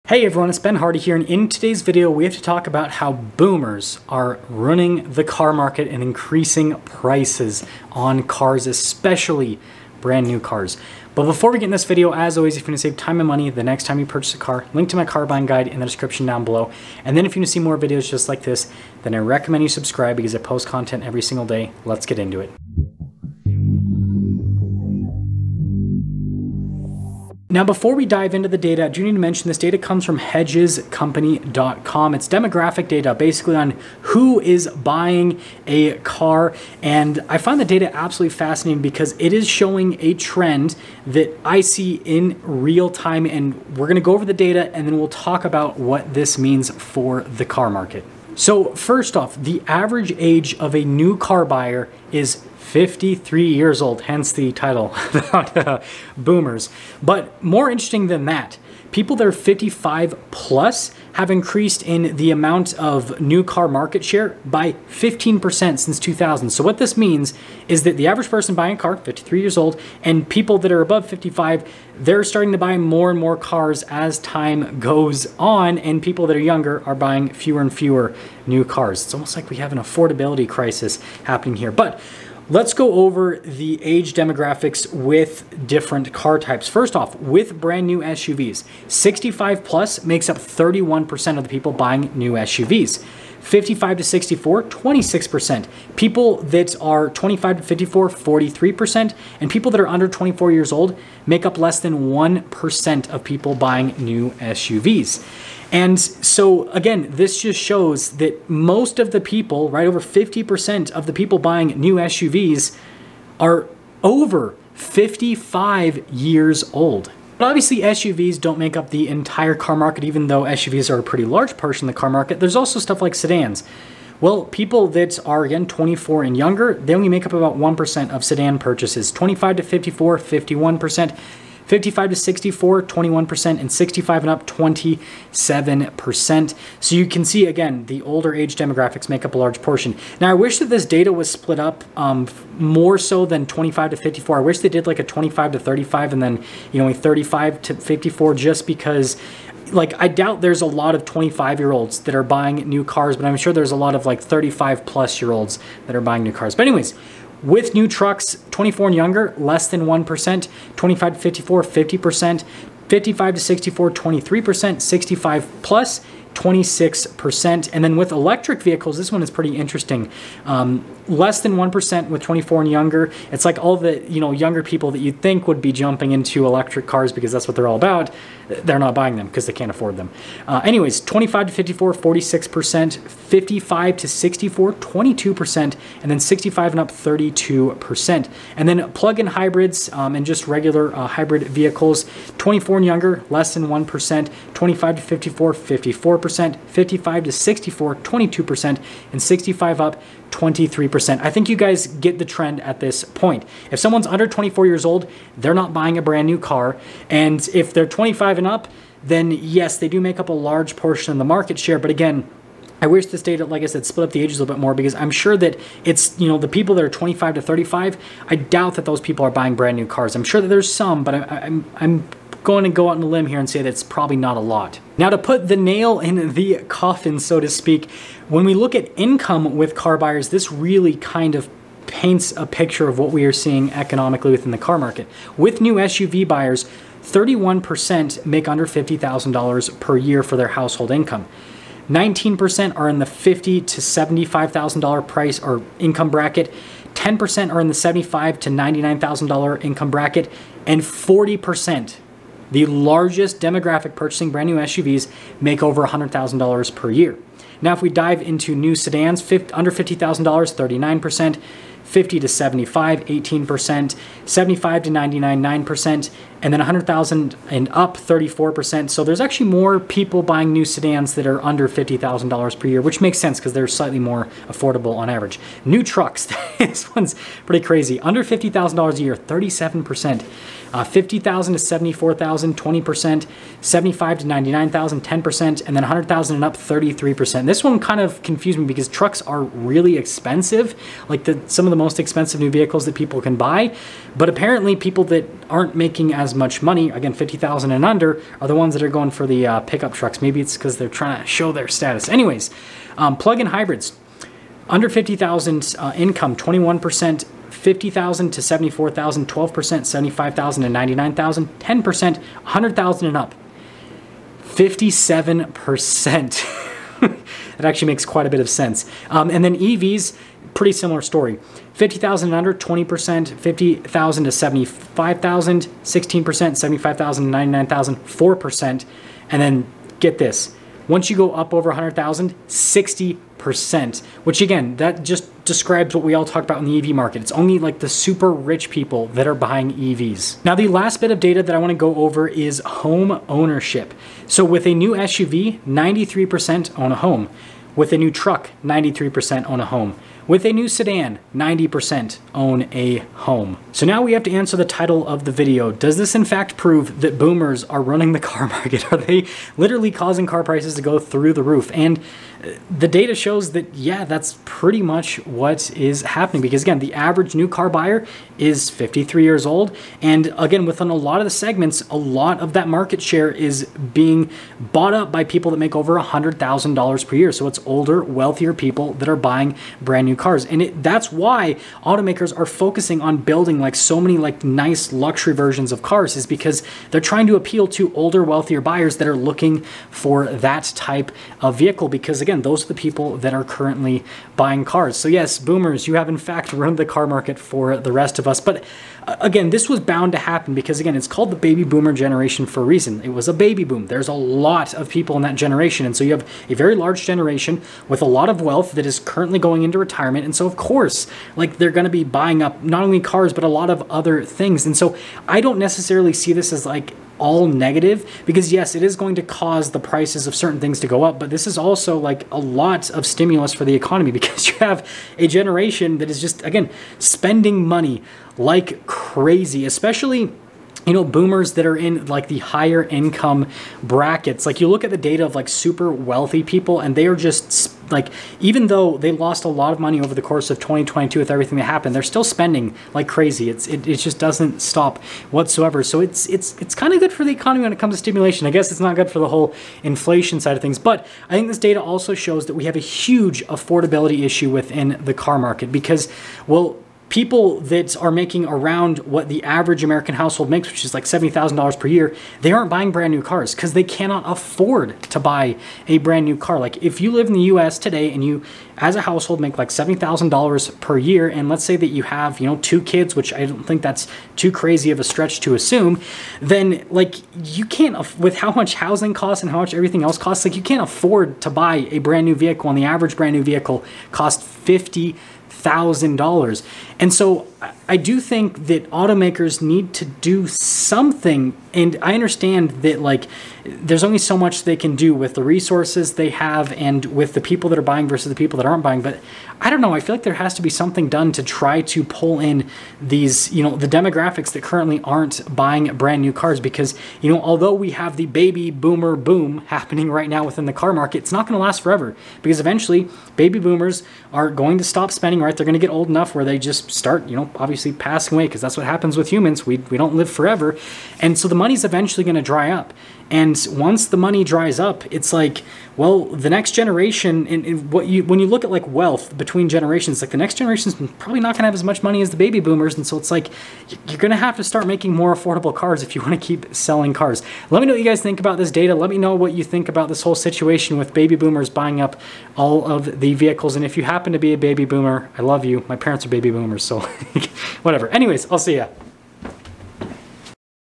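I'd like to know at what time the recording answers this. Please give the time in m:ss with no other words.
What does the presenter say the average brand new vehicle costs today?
8:04.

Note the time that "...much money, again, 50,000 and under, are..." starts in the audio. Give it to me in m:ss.
4:56.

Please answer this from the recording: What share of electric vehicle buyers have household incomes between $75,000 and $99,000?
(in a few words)
4%.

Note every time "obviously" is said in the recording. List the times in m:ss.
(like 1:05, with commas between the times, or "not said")
1:57, 8:37.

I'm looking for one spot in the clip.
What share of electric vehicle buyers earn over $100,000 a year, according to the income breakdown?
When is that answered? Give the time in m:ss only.
5:32.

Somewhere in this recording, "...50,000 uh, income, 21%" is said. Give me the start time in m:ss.
5:04.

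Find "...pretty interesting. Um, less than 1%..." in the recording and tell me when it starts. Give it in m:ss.
2:49.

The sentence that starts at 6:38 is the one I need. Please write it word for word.
But uh, again, this was bound to happen because again, it's called the baby boomer generation for a reason.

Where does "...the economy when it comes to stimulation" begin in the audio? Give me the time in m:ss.
7:27.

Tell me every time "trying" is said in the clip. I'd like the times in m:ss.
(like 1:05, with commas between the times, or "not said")
5:01, 6:27.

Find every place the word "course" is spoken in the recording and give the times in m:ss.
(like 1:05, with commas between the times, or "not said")
6:50, 7:20.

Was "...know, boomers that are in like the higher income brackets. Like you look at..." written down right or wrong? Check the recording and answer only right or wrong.
right.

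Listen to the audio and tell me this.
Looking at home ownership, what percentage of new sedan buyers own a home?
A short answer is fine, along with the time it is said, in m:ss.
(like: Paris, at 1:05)
90%, at 5:51.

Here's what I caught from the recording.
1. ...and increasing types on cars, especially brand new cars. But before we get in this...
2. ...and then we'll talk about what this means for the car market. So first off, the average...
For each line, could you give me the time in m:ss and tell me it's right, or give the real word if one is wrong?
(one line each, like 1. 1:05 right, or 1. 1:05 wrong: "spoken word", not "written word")
1. 0:05 wrong: "prices", not "types"
2. 0:44 right.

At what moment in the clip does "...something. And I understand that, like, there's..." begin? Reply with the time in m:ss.
8:10.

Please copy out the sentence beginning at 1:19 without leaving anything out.
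It's almost like we have an affordability crisis happening here.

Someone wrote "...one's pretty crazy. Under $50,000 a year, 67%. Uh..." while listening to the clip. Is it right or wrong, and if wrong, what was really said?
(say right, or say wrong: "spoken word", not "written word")
wrong: "37", not "67".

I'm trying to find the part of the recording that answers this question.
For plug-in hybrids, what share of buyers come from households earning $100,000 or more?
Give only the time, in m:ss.
5:14.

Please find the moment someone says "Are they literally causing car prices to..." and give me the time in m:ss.
5:58.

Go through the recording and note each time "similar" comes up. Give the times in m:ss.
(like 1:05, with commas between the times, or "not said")
5:20.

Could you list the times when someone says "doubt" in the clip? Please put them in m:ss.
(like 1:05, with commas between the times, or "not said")
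2:30, 3:38.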